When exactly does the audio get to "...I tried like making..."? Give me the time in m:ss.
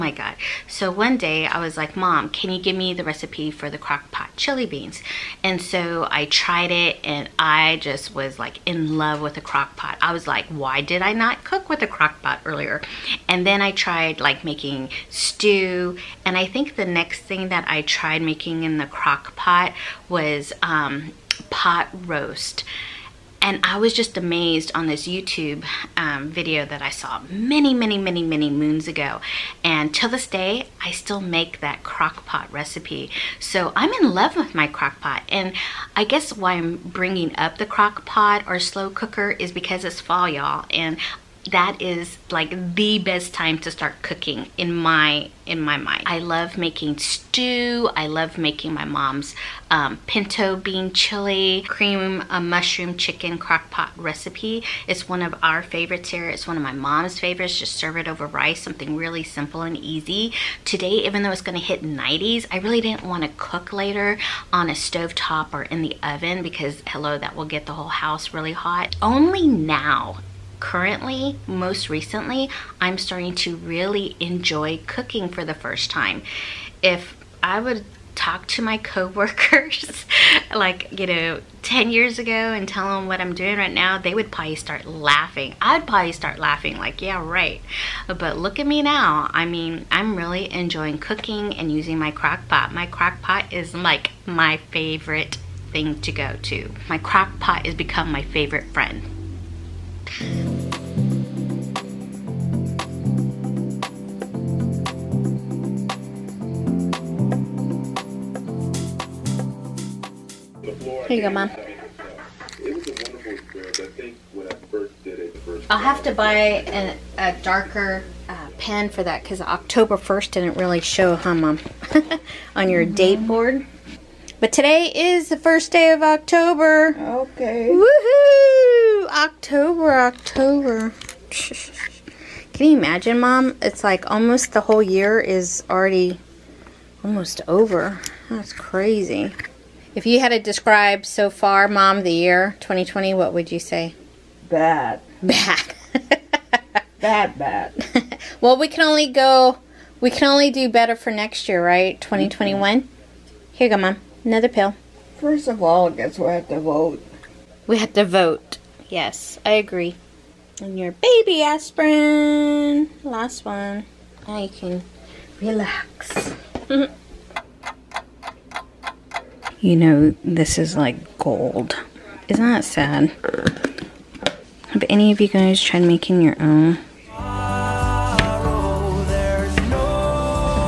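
0:13.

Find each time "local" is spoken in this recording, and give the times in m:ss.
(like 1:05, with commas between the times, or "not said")
not said.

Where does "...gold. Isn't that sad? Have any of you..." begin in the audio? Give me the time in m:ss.
2:51.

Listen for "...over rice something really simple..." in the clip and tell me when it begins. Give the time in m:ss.
0:58.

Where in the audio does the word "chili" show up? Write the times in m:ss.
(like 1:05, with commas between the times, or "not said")
0:04, 0:50.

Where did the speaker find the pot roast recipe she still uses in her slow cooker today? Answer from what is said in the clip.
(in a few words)
YouTube.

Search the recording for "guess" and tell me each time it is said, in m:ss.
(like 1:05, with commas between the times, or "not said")
0:36, 2:35.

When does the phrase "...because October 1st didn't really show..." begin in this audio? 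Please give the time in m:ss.
1:59.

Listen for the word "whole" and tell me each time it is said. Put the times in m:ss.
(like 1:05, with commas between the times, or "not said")
1:07, 2:14.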